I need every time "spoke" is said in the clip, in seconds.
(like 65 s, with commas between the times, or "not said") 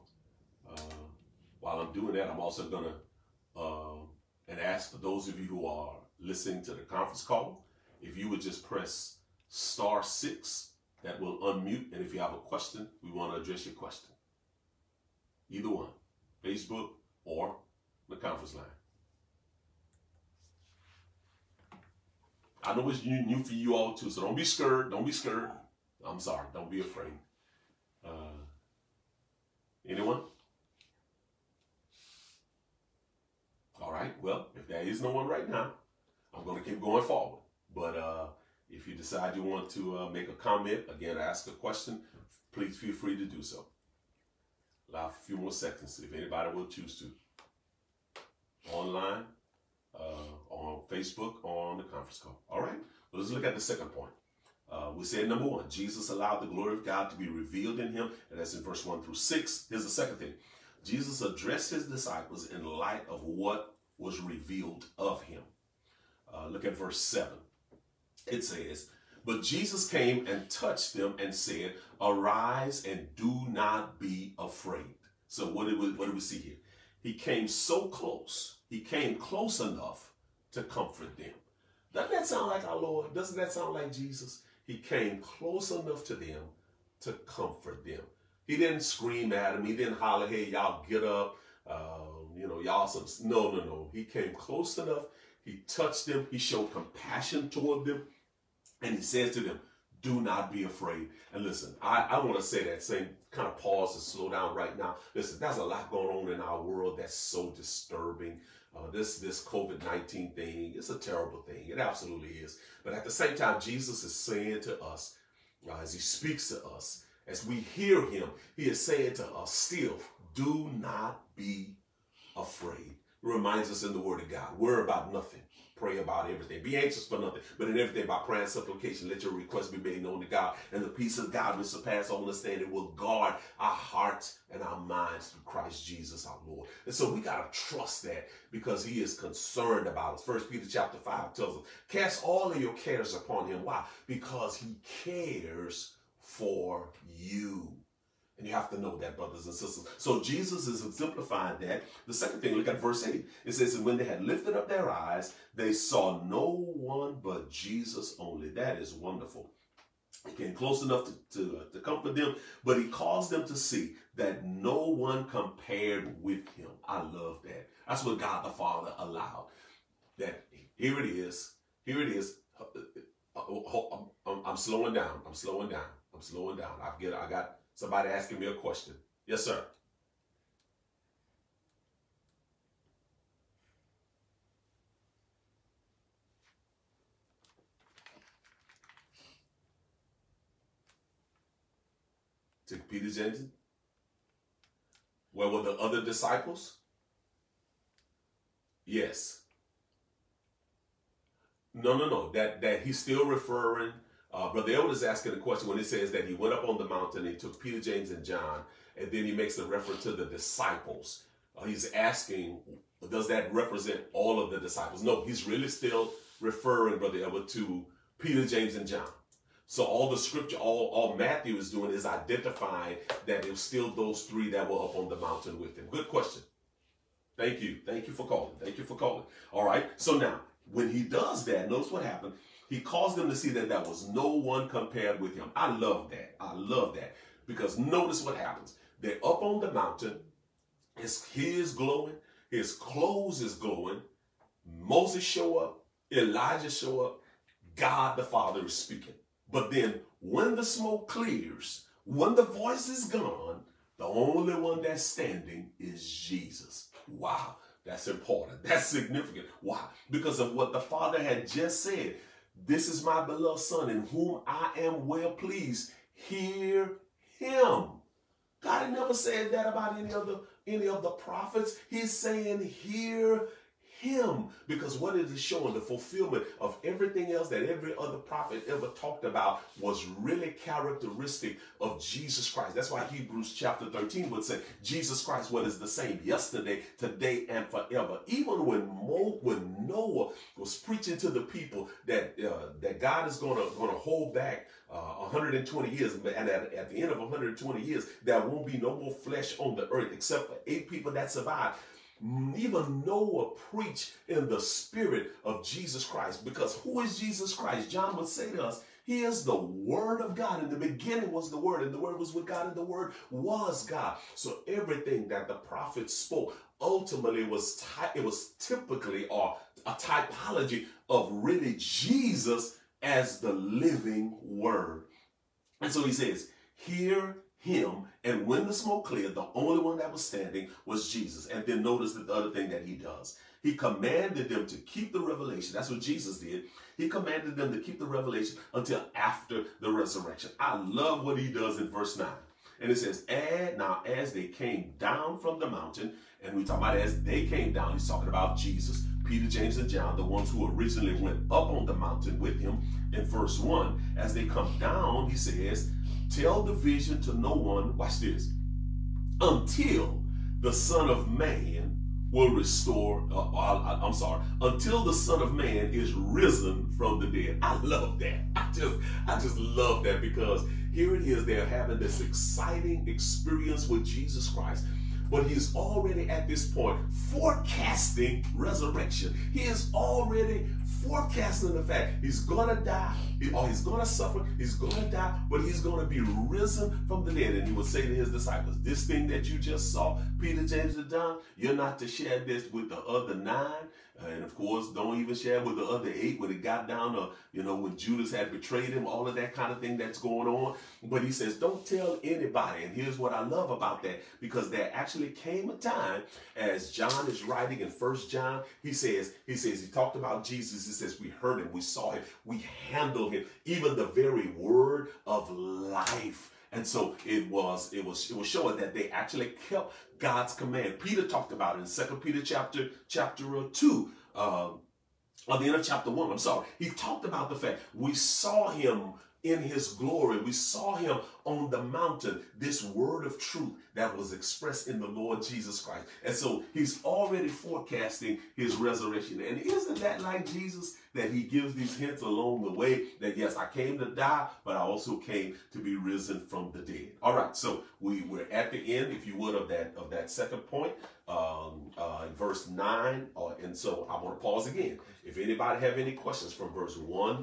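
316 s.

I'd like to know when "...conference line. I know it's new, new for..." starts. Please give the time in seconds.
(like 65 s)
18 s.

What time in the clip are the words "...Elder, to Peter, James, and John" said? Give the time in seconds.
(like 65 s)
217 s.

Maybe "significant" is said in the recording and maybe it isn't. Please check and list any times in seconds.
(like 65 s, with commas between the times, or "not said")
258 s.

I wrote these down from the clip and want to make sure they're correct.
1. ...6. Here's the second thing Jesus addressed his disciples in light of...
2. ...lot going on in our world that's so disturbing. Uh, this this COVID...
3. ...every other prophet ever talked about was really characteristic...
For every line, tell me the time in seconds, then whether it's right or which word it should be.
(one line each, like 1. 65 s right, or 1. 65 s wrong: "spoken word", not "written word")
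1. 59 s right
2. 105 s right
3. 277 s right.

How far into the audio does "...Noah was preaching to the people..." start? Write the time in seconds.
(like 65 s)
289 s.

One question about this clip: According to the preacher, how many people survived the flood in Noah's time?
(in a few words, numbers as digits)
8.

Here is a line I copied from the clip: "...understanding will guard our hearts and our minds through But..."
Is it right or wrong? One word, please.
wrong.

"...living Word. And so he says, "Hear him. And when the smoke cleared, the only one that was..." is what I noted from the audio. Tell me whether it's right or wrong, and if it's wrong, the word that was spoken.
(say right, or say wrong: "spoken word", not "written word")
right.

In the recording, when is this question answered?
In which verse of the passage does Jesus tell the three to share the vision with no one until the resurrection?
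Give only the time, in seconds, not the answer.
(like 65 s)
341 s.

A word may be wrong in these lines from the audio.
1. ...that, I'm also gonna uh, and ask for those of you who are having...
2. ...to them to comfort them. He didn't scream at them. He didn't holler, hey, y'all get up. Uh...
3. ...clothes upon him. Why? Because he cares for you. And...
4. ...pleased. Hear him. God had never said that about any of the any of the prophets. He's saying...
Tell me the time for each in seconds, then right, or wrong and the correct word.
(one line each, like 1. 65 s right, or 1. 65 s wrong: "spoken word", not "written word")
1. 2 s wrong: "listening", not "having"
2. 86 s right
3. 142 s wrong: "cares", not "clothes"
4. 265 s right.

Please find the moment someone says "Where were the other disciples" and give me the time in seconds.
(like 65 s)
195 s.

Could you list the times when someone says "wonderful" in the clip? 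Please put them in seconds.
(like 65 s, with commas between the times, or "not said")
158 s.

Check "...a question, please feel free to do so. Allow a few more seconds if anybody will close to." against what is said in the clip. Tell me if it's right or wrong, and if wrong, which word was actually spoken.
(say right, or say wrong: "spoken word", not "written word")
wrong: "choose", not "close".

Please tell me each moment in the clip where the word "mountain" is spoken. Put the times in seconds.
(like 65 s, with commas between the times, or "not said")
206 s, 225 s, 239 s, 345 s, 351 s, 431 s.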